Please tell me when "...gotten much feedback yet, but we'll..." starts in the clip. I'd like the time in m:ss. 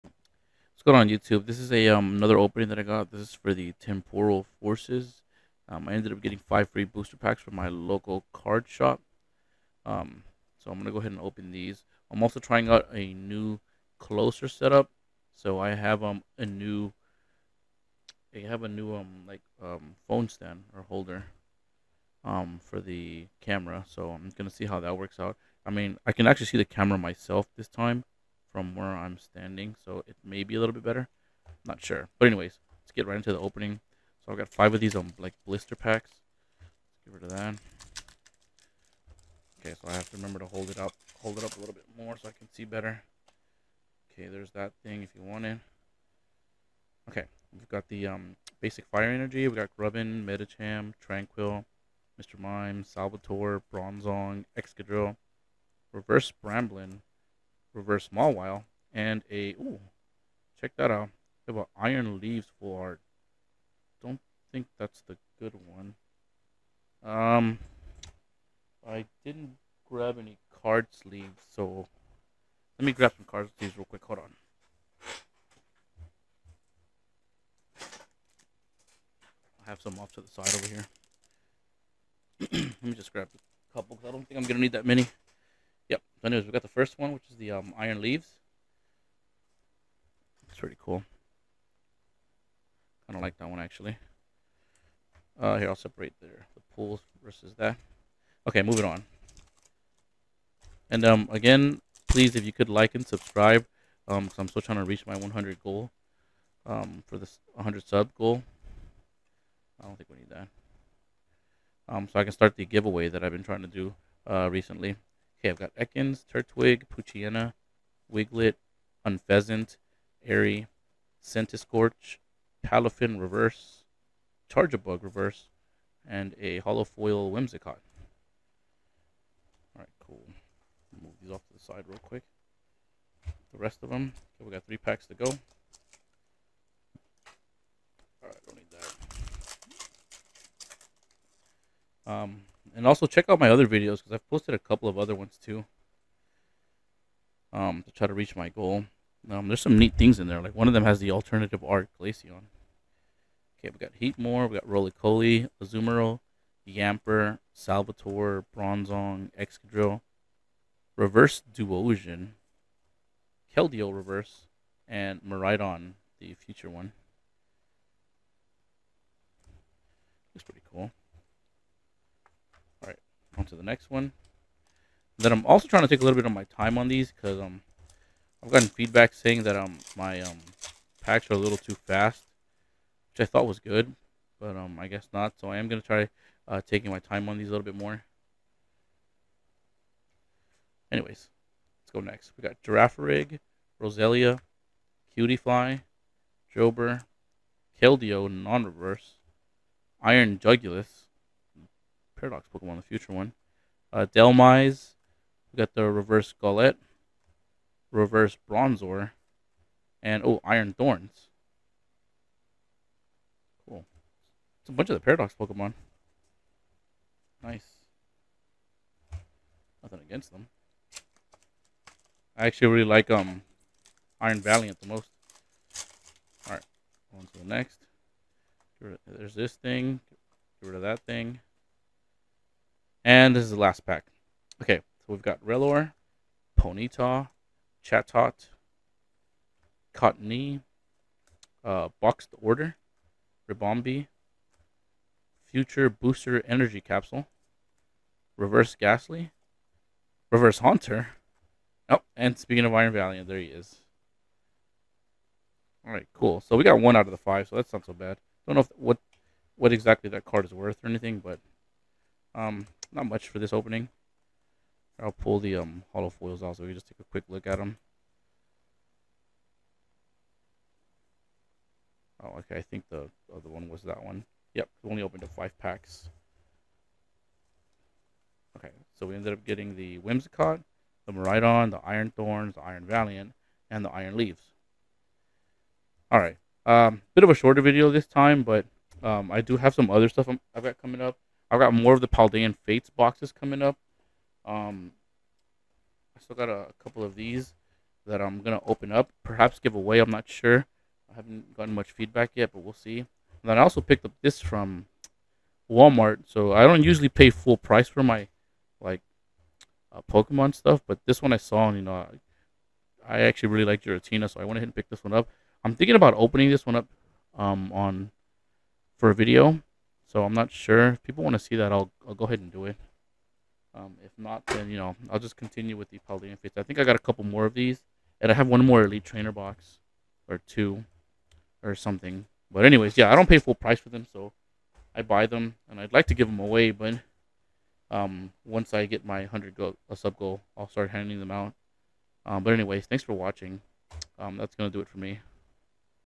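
5:01.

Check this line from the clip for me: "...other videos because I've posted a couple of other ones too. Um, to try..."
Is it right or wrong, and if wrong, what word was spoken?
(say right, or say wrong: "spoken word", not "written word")
right.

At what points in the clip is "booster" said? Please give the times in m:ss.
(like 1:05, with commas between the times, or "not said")
0:06, 4:05.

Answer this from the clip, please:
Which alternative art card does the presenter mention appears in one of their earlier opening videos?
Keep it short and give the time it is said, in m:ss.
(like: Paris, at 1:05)
Glaceon, at 2:31.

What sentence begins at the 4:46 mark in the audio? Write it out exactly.
Alright, um, bit of a shorter video this time, but um, I do have some other stuff i have got coming up.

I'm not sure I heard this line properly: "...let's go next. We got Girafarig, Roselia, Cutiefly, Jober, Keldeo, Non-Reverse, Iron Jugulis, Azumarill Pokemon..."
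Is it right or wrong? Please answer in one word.
wrong.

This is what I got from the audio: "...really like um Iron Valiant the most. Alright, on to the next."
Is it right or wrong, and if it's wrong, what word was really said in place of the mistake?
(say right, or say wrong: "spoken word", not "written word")
right.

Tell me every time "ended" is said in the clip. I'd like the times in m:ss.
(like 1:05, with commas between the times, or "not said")
0:05, 4:39.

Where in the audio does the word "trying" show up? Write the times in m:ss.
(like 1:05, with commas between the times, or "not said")
0:12, 1:44, 1:53, 2:55.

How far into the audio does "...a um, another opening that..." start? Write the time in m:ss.
0:01.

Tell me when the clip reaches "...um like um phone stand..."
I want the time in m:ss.
0:18.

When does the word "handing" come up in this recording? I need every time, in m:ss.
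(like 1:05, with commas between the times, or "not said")
5:40.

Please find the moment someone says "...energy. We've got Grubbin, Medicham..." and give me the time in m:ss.
0:49.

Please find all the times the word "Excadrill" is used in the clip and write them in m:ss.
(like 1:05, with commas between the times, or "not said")
0:54, 2:39.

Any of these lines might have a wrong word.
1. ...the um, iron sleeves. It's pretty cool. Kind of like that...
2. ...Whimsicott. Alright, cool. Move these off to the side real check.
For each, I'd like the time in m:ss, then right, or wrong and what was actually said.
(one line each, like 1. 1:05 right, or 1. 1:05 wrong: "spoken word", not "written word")
1. 1:27 wrong: "leaves", not "sleeves"
2. 2:07 wrong: "quick", not "check".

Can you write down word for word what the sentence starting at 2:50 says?
Looks pretty cool on to the next one.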